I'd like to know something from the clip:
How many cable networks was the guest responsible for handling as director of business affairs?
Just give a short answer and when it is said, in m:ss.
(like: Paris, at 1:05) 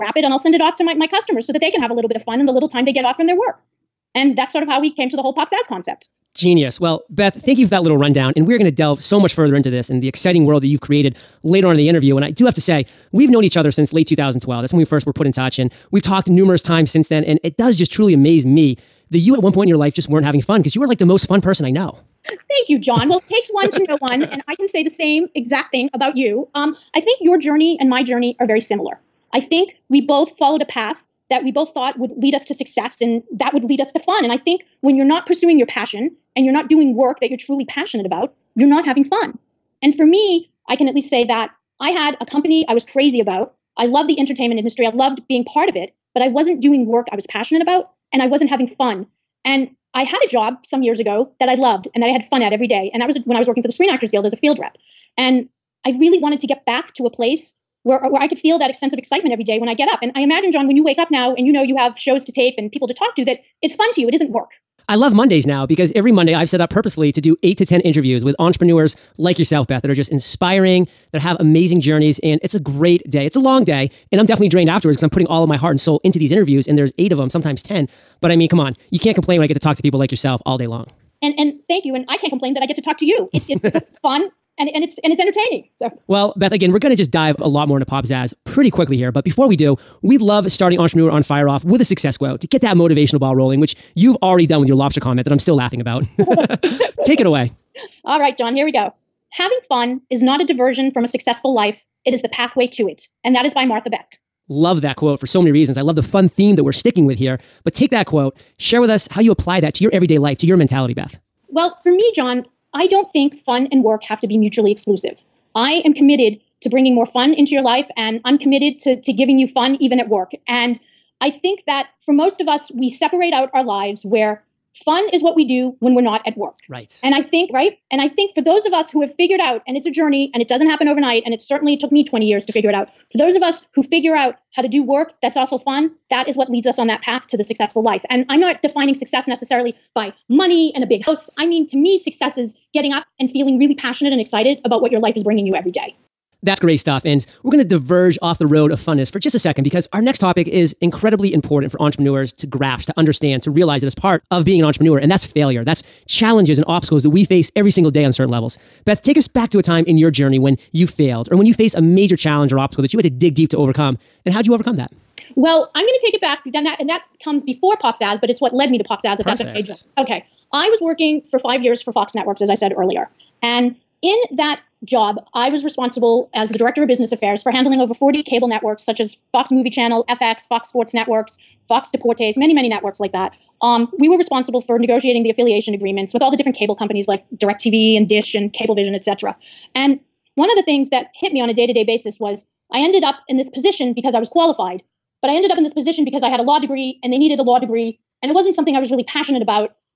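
Over 40, at 2:57.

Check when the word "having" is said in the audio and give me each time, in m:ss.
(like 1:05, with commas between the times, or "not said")
0:20, 0:38, 0:48, 1:39.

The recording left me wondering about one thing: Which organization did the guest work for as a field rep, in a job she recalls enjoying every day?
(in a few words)
Screen Actors Guild.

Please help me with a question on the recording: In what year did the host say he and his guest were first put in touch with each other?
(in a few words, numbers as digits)
2012.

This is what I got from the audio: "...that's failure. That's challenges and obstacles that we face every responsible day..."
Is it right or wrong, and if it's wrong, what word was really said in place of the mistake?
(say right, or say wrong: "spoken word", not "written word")
wrong: "single", not "responsible".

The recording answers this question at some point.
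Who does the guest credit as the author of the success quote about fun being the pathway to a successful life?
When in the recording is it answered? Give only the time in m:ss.
1:43.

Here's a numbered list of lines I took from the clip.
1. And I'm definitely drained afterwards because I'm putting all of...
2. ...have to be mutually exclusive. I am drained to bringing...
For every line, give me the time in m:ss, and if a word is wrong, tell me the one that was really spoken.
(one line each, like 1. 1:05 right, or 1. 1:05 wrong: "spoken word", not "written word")
1. 1:14 right
2. 1:54 wrong: "committed", not "drained".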